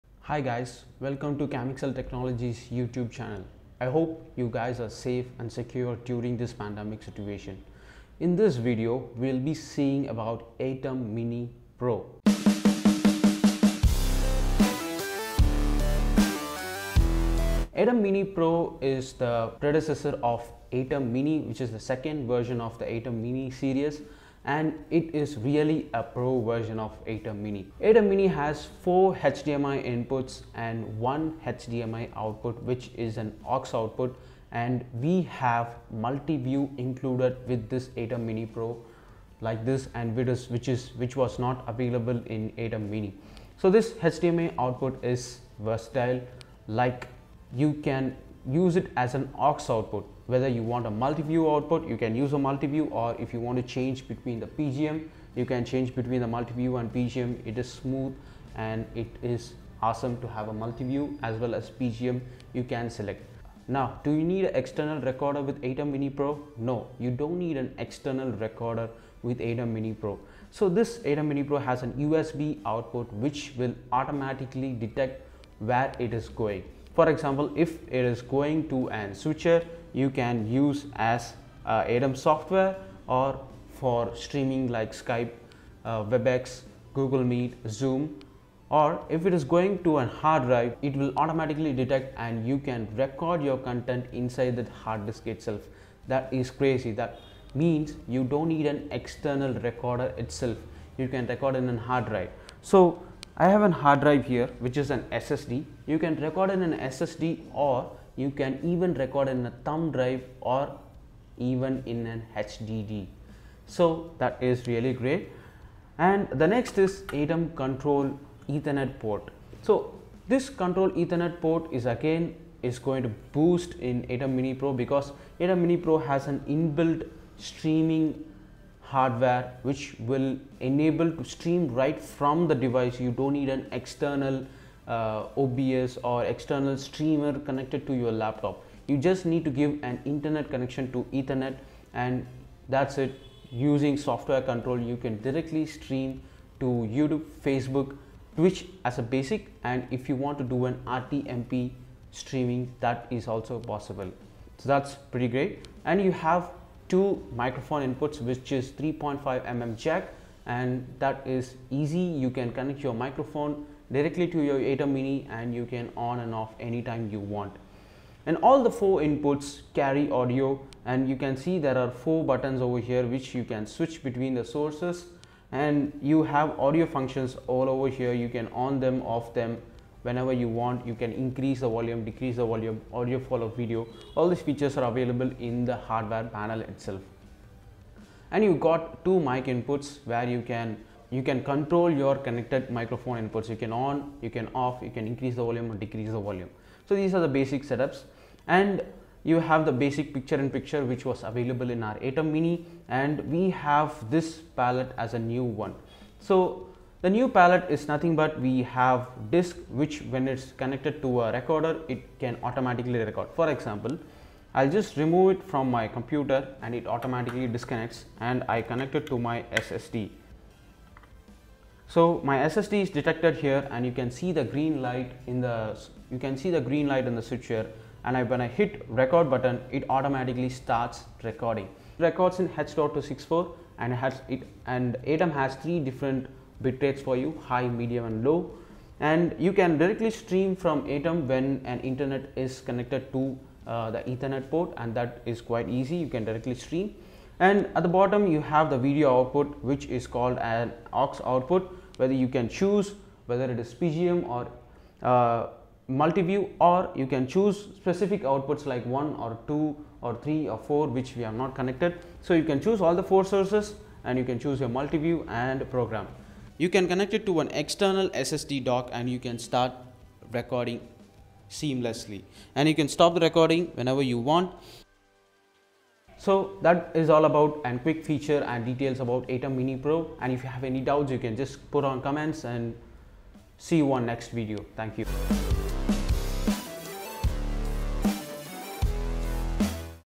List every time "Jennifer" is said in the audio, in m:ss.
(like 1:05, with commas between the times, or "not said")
not said.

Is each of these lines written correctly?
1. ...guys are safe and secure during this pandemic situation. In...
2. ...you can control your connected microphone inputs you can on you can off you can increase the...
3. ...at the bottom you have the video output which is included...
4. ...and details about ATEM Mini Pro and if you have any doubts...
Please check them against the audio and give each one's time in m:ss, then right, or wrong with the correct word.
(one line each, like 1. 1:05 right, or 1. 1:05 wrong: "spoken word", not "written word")
1. 0:04 right
2. 3:11 right
3. 4:07 wrong: "called", not "included"
4. 4:38 right.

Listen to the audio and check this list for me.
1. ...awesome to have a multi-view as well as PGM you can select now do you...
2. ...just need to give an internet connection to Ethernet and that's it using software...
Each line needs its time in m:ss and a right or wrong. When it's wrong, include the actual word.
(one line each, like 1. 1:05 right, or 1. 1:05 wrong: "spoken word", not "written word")
1. 0:59 right
2. 2:18 right.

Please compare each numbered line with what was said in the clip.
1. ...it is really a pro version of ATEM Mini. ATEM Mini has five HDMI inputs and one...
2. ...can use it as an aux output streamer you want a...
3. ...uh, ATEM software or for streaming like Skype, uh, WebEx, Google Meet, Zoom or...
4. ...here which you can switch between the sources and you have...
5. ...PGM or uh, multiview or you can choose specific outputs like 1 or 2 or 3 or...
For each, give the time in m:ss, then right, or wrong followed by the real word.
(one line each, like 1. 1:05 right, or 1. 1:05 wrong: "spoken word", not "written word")
1. 0:24 wrong: "four", not "five"
2. 0:47 wrong: "whether", not "streamer"
3. 1:21 right
4. 2:52 right
5. 4:13 right.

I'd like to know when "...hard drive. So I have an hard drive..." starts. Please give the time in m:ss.
1:41.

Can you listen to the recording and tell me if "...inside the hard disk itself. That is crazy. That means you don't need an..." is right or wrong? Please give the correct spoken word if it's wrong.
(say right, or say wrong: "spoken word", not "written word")
right.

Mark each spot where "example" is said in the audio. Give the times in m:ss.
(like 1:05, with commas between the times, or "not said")
1:17, 3:33.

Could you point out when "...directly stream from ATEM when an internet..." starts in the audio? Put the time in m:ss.
3:59.